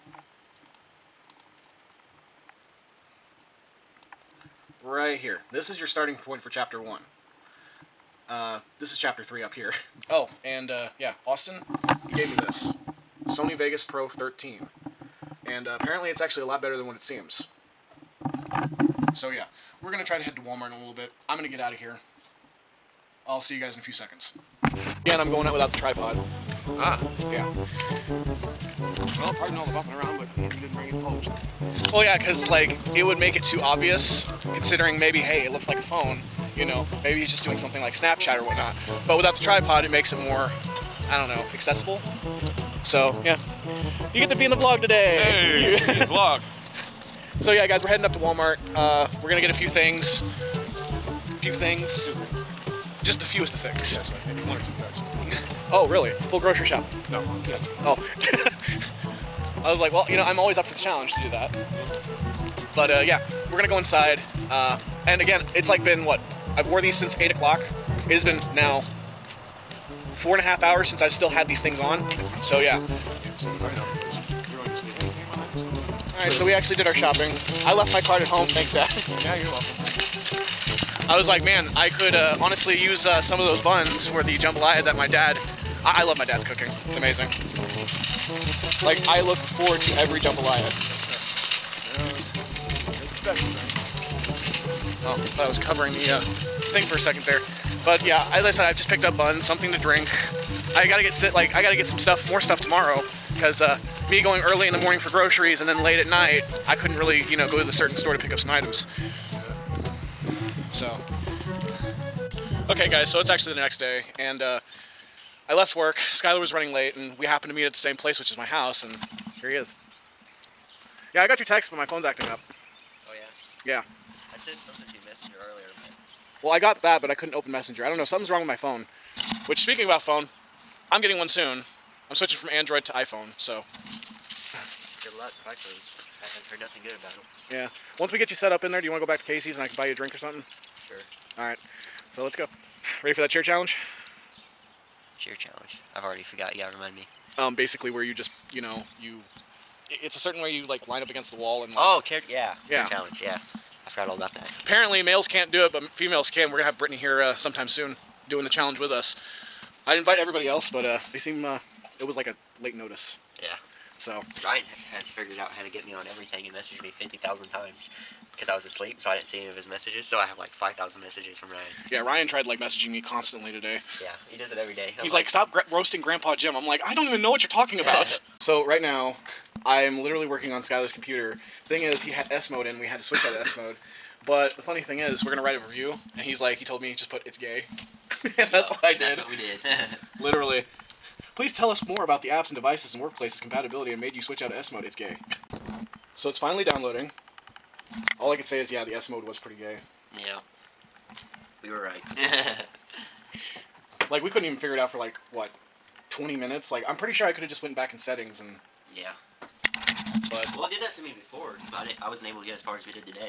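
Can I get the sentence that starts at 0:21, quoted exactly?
I'm going to get out of here.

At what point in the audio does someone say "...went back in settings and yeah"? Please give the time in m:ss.
3:27.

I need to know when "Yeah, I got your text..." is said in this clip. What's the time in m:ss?
2:01.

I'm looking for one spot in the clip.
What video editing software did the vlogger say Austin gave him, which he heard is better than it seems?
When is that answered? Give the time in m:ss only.
0:13.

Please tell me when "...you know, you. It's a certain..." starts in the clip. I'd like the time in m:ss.
2:28.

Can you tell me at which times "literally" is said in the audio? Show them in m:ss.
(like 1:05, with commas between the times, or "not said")
3:00, 3:10.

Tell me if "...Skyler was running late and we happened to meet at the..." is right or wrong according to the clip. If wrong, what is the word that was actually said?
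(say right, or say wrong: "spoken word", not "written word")
right.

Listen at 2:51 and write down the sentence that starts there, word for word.
Yeah, Ryan tried like messaging me constantly today.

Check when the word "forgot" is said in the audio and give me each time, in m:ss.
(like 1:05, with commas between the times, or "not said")
2:26, 2:33.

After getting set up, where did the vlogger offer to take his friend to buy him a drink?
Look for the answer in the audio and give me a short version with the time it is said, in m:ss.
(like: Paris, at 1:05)
Casey's, at 2:19.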